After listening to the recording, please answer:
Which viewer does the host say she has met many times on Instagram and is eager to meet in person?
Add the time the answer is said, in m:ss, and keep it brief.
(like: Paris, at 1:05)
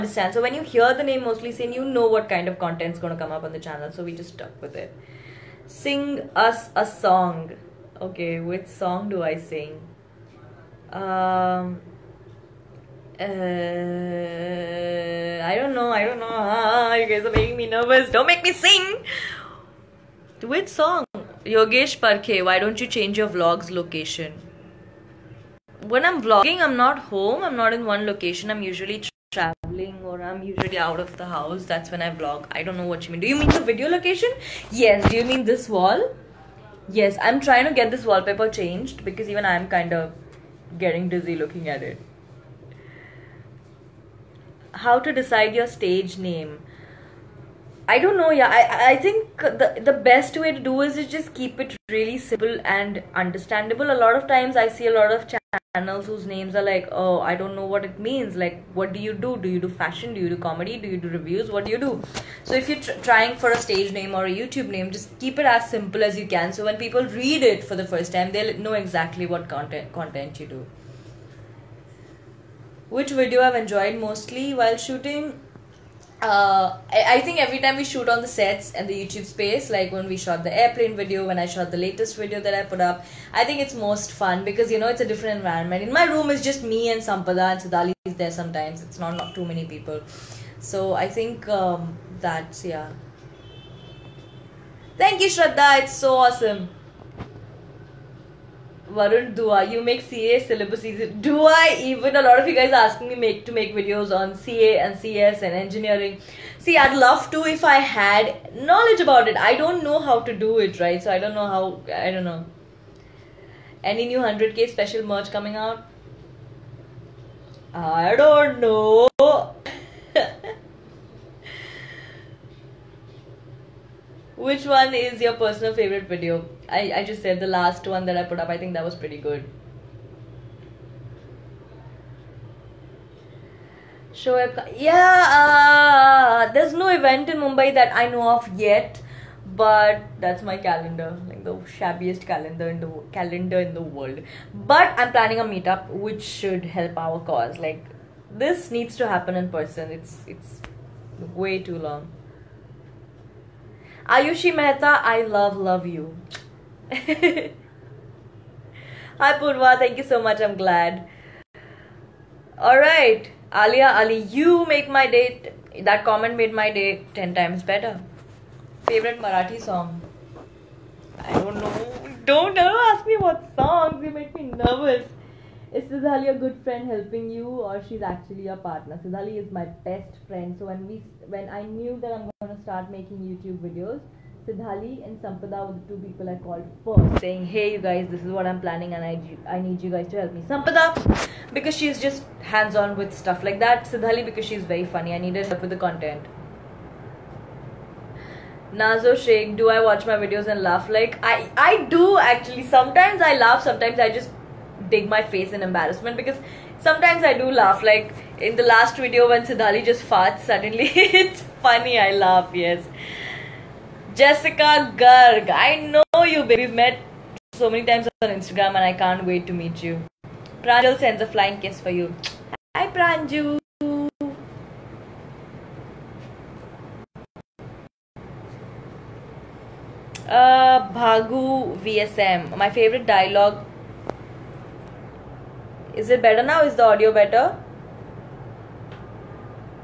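Jessica Garg, at 3:34.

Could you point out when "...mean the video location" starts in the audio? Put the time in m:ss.
0:33.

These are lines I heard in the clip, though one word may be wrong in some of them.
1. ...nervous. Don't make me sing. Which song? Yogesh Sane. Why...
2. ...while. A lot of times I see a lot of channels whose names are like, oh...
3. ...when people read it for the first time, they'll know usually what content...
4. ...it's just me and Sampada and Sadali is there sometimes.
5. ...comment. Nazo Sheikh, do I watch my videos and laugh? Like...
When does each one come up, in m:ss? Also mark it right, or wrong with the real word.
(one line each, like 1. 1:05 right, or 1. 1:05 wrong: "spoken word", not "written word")
1. 0:17 wrong: "Parkhe", not "Sane"
2. 0:53 wrong: "understandable", not "while"
3. 1:06 wrong: "exactly", not "usually"
4. 1:26 right
5. 3:15 wrong: "content", not "comment".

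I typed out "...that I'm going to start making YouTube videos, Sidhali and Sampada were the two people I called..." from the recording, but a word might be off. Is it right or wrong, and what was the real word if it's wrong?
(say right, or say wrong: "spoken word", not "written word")
right.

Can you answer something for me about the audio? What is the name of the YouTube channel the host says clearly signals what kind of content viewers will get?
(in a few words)
Mostly Sane.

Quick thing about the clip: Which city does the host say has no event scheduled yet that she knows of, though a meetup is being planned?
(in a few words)
Mumbai.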